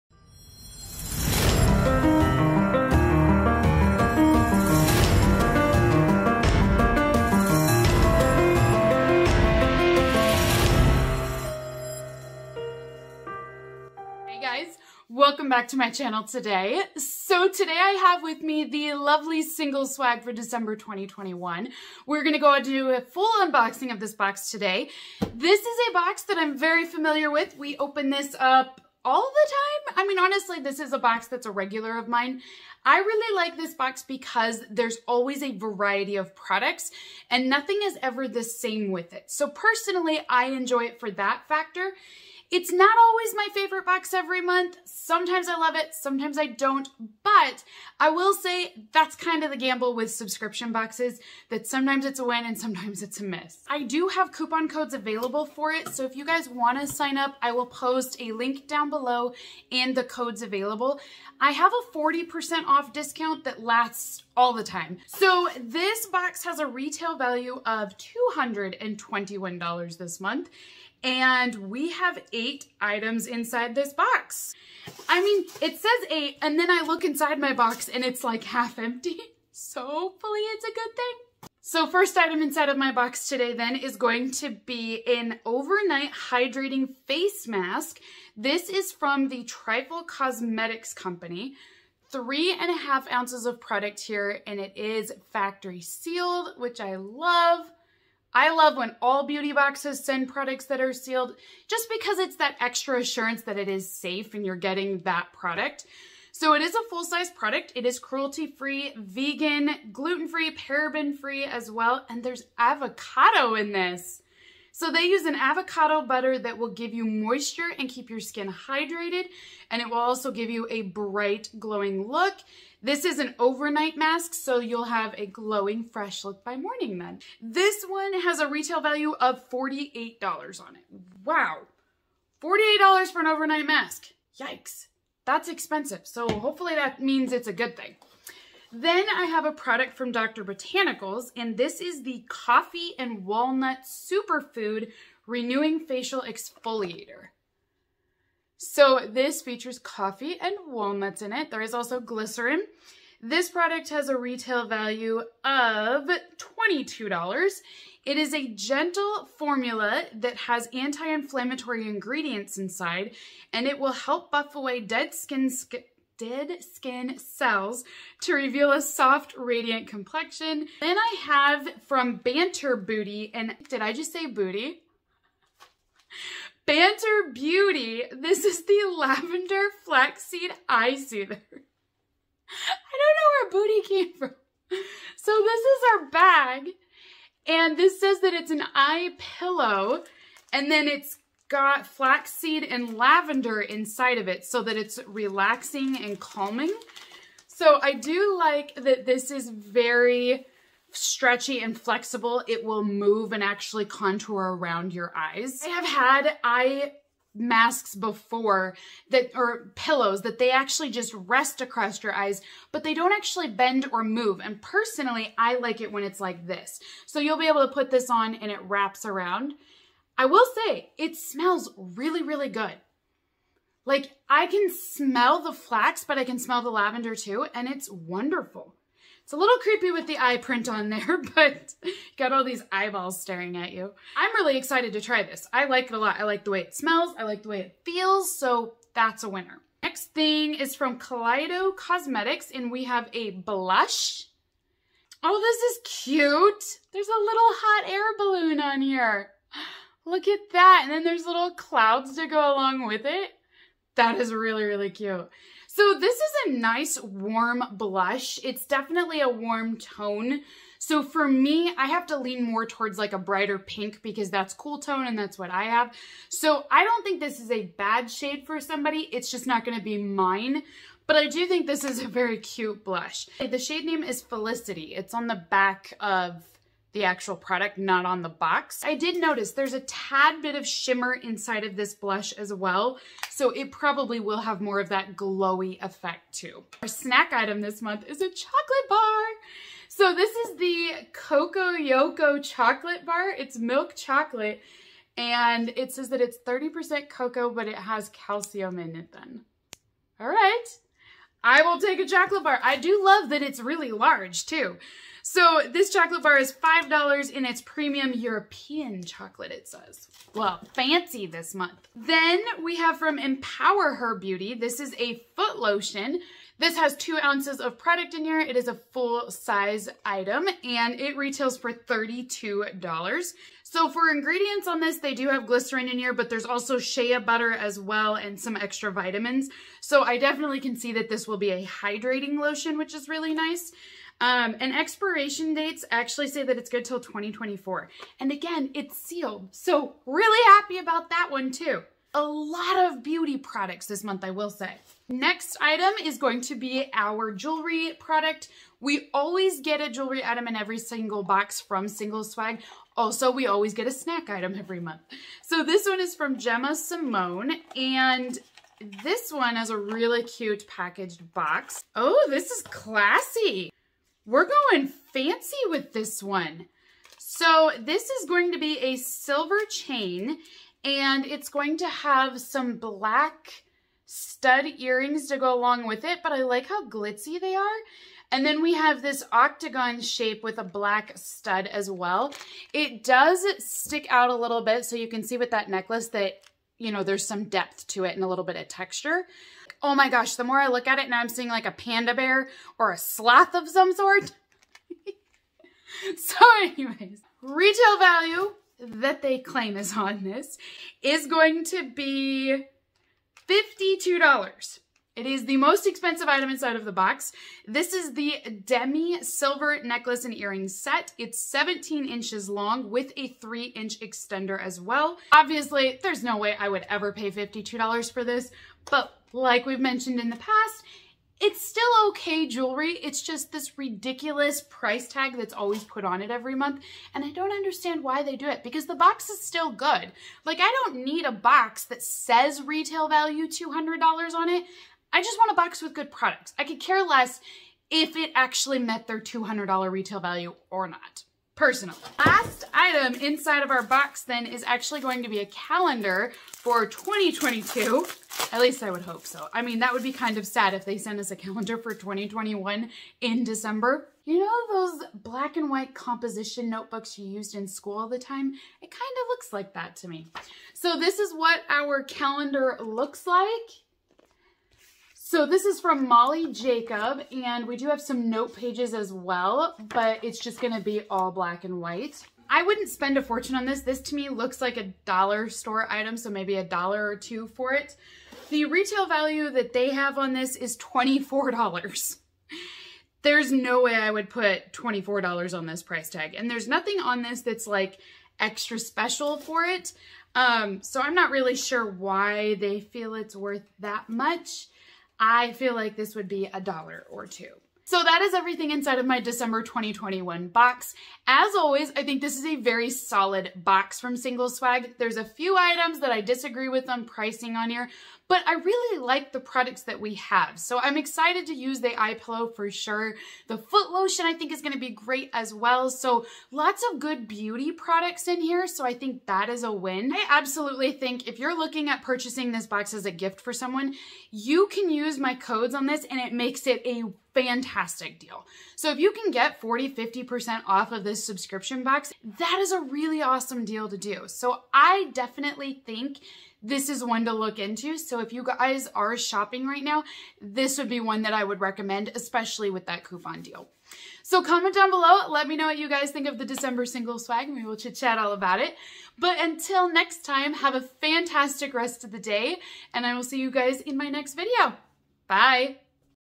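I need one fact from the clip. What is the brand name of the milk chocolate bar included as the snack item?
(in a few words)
Coco Yoko.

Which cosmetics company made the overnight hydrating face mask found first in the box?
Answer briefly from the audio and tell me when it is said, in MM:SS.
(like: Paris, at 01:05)
Trifle Cosmetics, at 01:29.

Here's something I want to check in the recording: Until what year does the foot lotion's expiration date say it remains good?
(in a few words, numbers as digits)
2024.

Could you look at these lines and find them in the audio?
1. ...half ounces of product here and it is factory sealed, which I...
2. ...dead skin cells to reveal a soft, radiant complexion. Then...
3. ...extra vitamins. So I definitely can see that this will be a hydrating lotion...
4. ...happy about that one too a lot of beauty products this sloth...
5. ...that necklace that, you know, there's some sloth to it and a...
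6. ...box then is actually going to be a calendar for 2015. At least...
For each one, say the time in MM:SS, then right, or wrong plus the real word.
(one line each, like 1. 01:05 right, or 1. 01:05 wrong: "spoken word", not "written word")
1. 01:32 right
2. 02:46 right
3. 05:28 right
4. 05:40 wrong: "month", not "sloth"
5. 06:25 wrong: "depth", not "sloth"
6. 07:23 wrong: "2022", not "2015".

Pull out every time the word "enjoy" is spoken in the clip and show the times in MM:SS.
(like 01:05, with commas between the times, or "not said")
00:40.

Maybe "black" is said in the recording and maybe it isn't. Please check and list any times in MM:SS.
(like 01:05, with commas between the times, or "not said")
06:12, 06:20, 07:35, 07:51.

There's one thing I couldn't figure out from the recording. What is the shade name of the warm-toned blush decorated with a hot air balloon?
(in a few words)
Felicity.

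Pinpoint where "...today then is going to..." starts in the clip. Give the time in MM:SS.
01:23.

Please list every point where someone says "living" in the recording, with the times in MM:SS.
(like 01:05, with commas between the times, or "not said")
not said.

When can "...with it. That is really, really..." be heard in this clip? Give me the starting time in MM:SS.
04:12.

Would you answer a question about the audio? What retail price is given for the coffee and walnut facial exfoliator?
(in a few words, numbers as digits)
$22.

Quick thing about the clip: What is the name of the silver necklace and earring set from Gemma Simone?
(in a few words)
Demi.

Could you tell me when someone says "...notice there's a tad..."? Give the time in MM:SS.
04:39.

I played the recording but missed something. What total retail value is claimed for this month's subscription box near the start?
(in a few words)
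$221.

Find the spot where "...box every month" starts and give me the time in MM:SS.
00:43.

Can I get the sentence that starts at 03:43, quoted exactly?
Like I can smell the flax, but I can smell the lavender too.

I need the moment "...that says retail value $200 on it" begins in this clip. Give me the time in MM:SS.
07:11.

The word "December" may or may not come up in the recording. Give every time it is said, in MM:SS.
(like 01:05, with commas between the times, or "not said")
00:20, 07:33, 08:19, 09:06.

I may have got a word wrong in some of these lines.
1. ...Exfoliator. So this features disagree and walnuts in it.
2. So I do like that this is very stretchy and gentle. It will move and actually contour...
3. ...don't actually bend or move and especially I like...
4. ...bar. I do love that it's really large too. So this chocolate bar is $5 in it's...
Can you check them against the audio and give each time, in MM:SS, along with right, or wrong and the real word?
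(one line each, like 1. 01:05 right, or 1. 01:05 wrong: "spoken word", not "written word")
1. 02:26 wrong: "coffee", not "disagree"
2. 03:17 wrong: "flexible", not "gentle"
3. 03:32 wrong: "personally", not "especially"
4. 05:02 right.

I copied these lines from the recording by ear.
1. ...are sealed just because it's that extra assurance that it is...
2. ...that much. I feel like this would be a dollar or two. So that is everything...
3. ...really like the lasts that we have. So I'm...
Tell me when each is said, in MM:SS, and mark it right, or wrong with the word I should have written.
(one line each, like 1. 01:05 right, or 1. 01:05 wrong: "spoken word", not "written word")
1. 01:40 right
2. 08:13 right
3. 08:28 wrong: "products", not "lasts".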